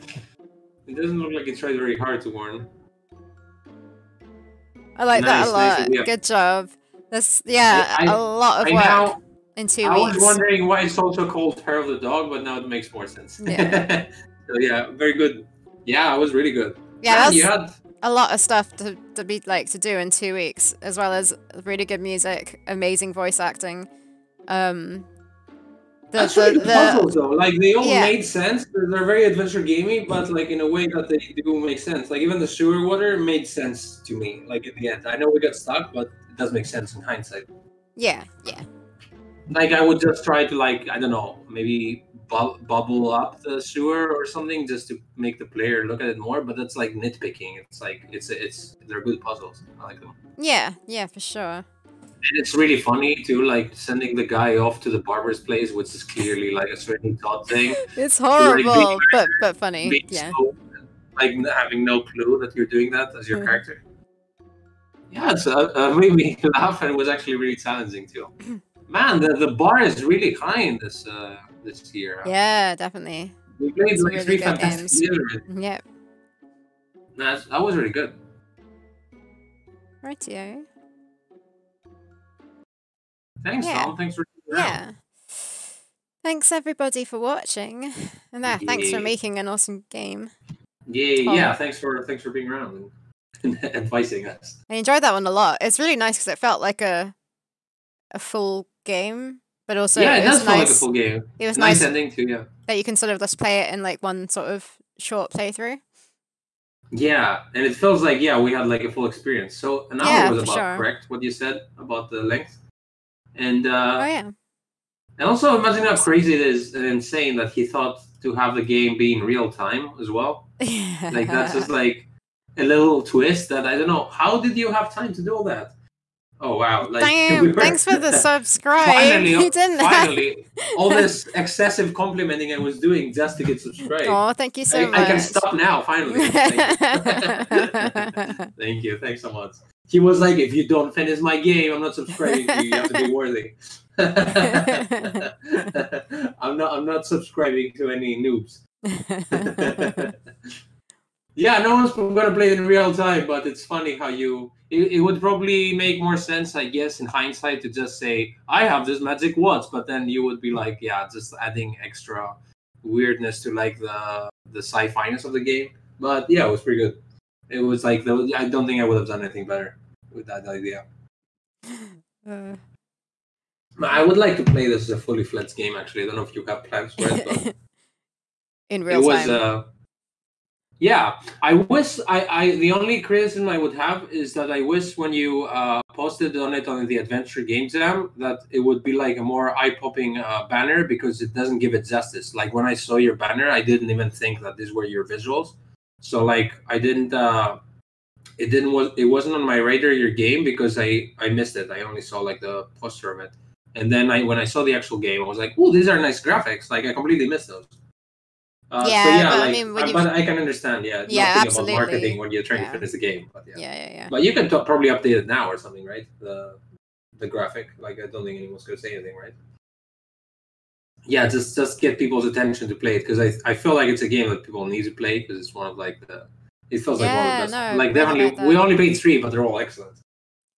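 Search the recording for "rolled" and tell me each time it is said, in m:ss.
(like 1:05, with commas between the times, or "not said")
not said.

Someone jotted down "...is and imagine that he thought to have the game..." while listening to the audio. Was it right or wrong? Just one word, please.
wrong.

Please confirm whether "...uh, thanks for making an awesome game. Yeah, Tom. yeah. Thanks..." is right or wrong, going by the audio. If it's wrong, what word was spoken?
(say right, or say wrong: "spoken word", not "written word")
right.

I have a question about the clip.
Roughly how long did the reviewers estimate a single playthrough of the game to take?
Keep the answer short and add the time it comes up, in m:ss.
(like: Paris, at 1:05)
An hour, at 1:49.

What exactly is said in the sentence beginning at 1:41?
It was nice, nice ending too.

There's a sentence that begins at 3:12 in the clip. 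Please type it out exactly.
Like when I saw your banner, I didn't even think that these were your visuals.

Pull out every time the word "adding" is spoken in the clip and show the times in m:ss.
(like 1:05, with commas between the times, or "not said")
2:41.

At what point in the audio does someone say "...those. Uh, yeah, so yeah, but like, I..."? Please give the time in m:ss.
3:27.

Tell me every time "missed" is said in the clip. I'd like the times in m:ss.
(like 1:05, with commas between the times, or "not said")
3:21, 3:27.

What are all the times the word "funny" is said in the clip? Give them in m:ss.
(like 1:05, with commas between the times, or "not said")
0:52, 0:59, 2:33.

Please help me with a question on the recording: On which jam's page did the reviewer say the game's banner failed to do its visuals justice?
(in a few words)
Adventure Game Jam.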